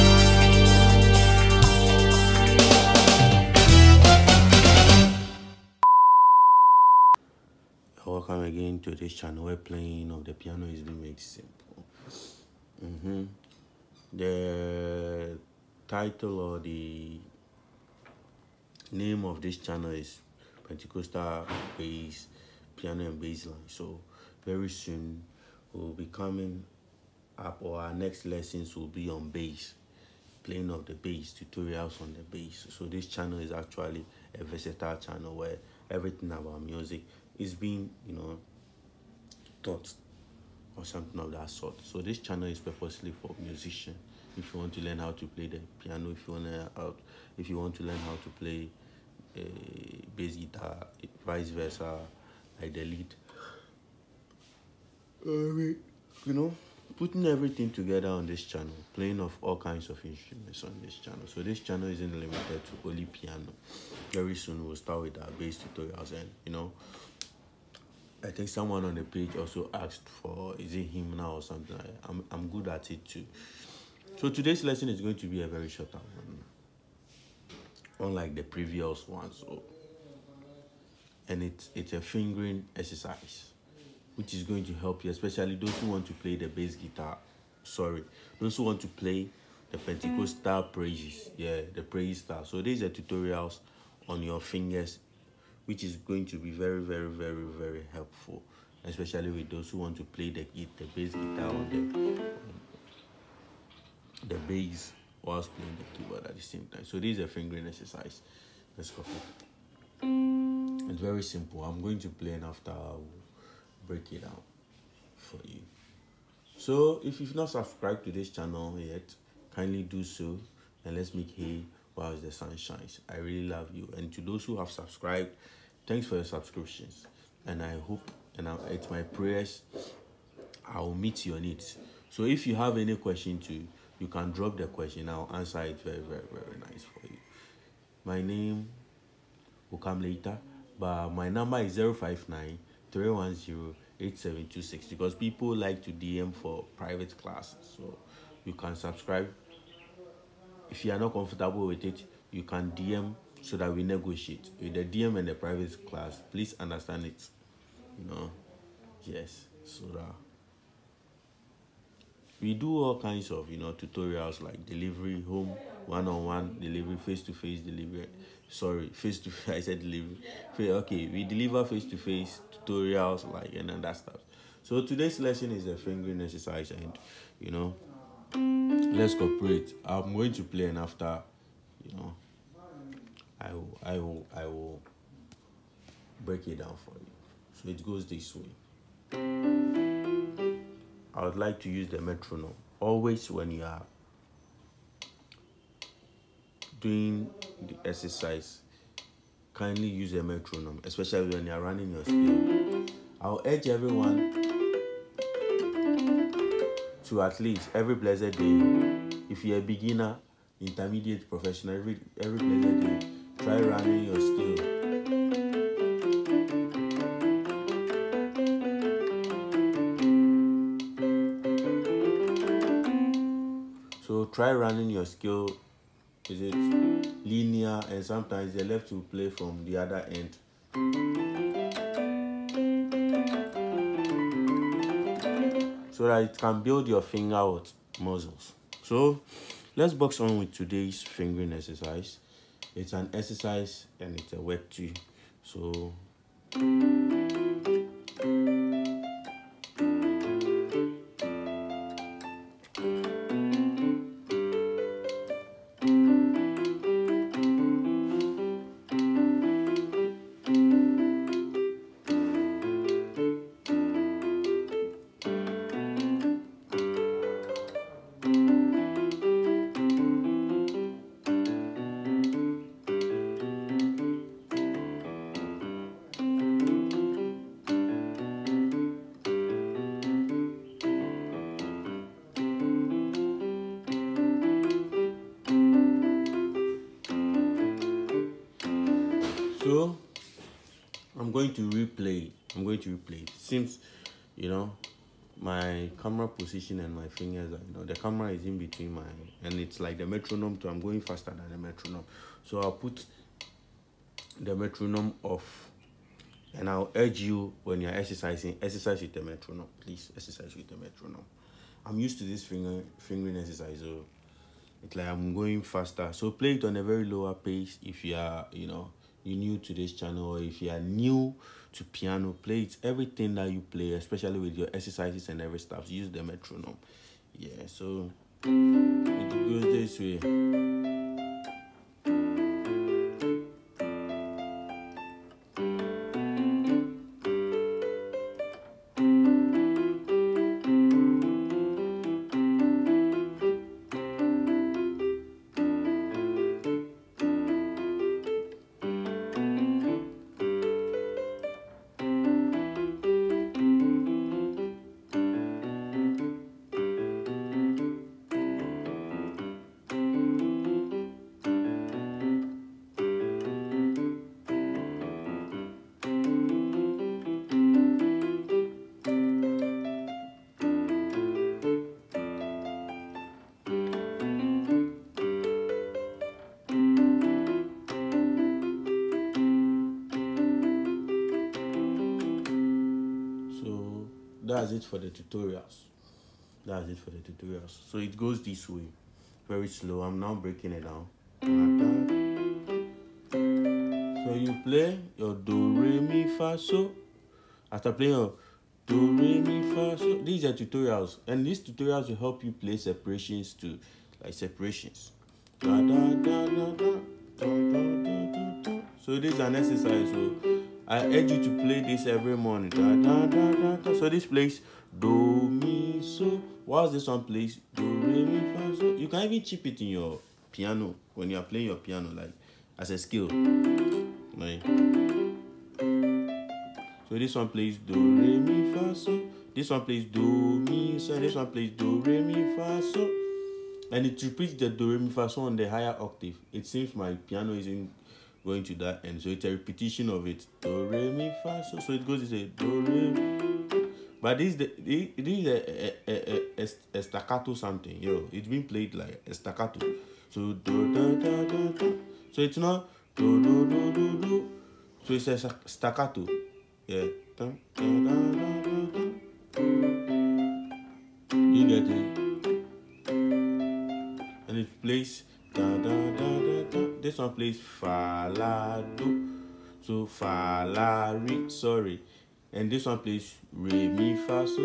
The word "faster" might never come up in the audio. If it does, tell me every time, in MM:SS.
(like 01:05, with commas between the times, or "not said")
05:01, 05:15.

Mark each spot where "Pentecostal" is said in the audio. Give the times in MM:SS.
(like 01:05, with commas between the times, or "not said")
00:20, 01:29.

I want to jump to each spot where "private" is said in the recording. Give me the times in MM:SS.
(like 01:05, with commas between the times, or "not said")
02:26, 02:35.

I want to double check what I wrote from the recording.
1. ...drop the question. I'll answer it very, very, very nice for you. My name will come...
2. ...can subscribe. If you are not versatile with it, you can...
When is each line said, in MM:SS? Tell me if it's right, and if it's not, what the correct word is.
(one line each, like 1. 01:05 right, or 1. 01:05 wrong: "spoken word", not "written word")
1. 02:14 right
2. 02:28 wrong: "comfortable", not "versatile".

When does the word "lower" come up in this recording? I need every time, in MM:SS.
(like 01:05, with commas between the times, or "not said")
05:17.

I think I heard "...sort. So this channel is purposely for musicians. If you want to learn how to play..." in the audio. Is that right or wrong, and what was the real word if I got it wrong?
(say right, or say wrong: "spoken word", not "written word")
right.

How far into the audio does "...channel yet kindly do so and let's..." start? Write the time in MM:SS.
01:58.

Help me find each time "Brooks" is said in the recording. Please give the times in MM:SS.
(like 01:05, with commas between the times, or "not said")
not said.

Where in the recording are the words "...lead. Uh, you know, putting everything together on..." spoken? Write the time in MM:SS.
00:52.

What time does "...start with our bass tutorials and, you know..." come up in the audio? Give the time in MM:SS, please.
01:04.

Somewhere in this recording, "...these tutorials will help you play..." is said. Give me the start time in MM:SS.
06:41.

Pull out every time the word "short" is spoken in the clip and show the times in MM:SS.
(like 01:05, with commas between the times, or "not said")
01:15.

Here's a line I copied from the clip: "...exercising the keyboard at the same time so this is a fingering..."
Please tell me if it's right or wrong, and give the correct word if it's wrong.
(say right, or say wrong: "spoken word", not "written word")
wrong: "playing", not "exercising".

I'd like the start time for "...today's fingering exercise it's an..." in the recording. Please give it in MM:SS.
04:00.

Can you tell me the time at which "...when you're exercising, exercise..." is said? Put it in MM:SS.
05:07.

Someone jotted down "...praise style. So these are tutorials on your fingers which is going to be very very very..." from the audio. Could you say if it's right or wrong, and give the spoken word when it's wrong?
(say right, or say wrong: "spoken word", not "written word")
right.